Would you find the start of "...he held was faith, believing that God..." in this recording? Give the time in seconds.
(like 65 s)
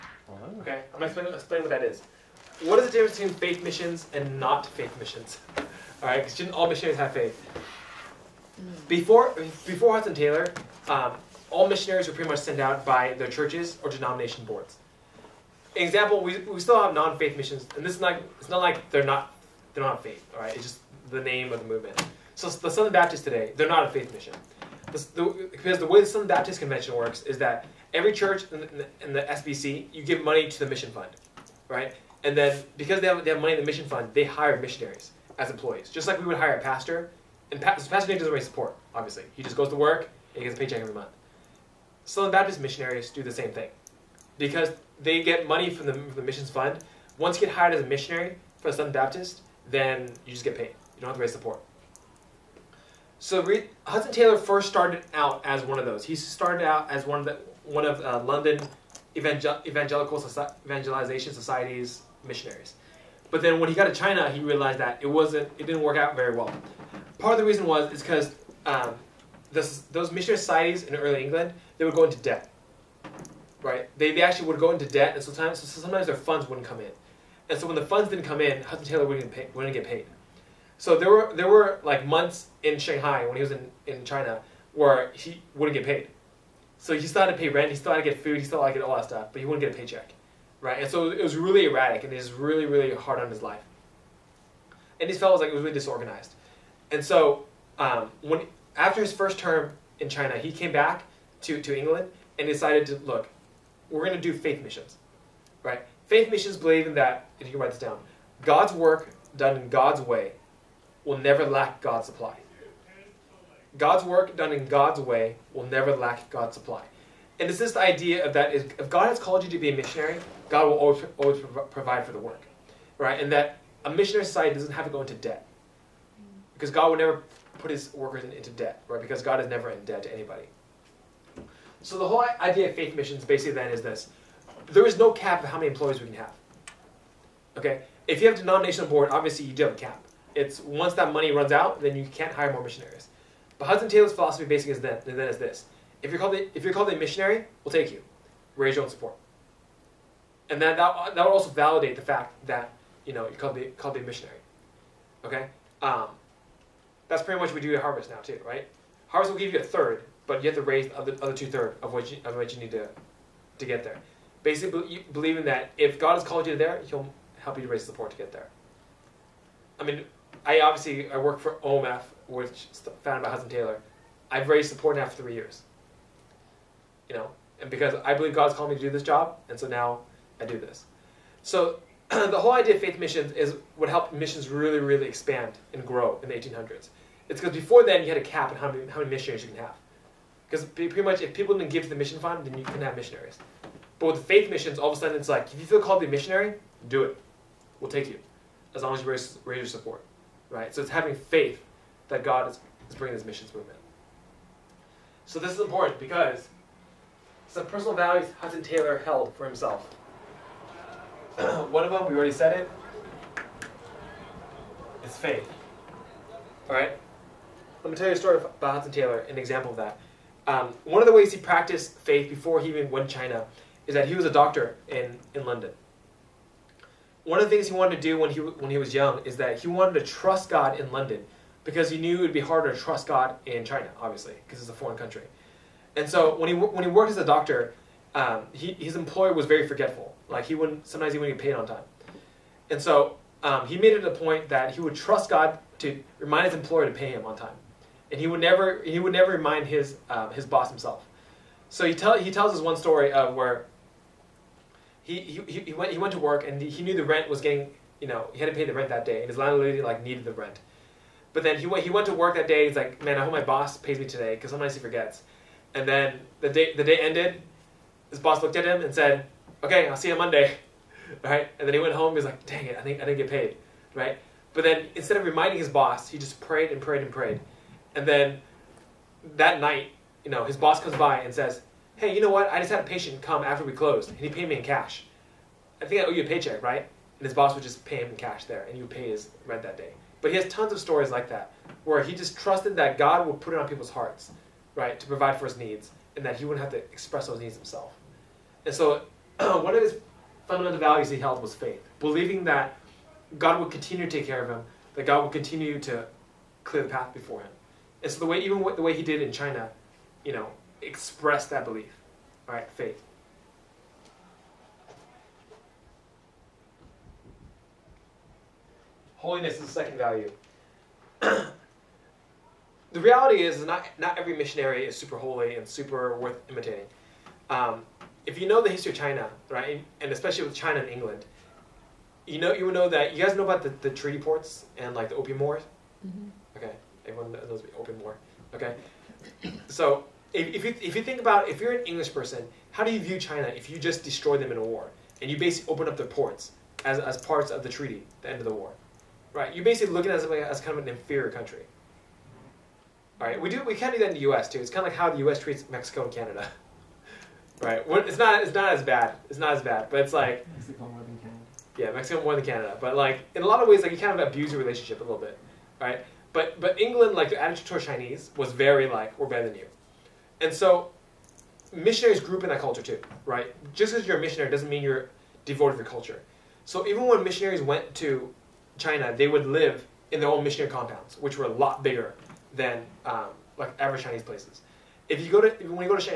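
301 s.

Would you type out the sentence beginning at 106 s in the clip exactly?
Faith missions believe in that, if you can write this down, God's work done in God's way will never lack God's supply.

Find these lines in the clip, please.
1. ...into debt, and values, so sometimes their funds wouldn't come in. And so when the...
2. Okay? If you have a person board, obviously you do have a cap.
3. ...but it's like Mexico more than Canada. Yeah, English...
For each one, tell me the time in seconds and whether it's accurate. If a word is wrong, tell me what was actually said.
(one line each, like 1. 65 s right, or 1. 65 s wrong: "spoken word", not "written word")
1. 74 s wrong: "sometimes", not "values"
2. 137 s wrong: "denomination", not "person"
3. 359 s wrong: "Mexico", not "English".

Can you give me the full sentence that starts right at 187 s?
It's because before then you had a cap on how many, how many missionaries you can have.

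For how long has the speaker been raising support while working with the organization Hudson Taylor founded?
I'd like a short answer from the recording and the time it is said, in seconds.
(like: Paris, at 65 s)
3 years, at 175 s.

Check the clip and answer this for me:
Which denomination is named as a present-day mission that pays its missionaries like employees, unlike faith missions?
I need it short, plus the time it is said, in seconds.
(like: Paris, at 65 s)
Southern Baptists, at 22 s.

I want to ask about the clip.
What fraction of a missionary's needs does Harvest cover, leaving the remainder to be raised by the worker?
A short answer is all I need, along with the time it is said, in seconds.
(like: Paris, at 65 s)
a third, at 159 s.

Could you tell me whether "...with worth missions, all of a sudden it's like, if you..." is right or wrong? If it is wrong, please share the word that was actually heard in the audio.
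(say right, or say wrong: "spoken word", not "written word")
wrong: "faith", not "worth".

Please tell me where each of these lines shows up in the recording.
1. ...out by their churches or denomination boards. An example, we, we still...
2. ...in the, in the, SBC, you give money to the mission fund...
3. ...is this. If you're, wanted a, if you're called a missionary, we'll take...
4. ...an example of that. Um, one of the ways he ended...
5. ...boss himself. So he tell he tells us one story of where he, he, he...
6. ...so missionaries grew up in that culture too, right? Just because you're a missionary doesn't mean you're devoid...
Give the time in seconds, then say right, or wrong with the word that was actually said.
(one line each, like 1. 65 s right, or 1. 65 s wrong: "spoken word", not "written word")
1. 12 s right
2. 28 s right
3. 145 s wrong: "called", not "wanted"
4. 219 s wrong: "practiced", not "ended"
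5. 250 s right
6. 370 s right.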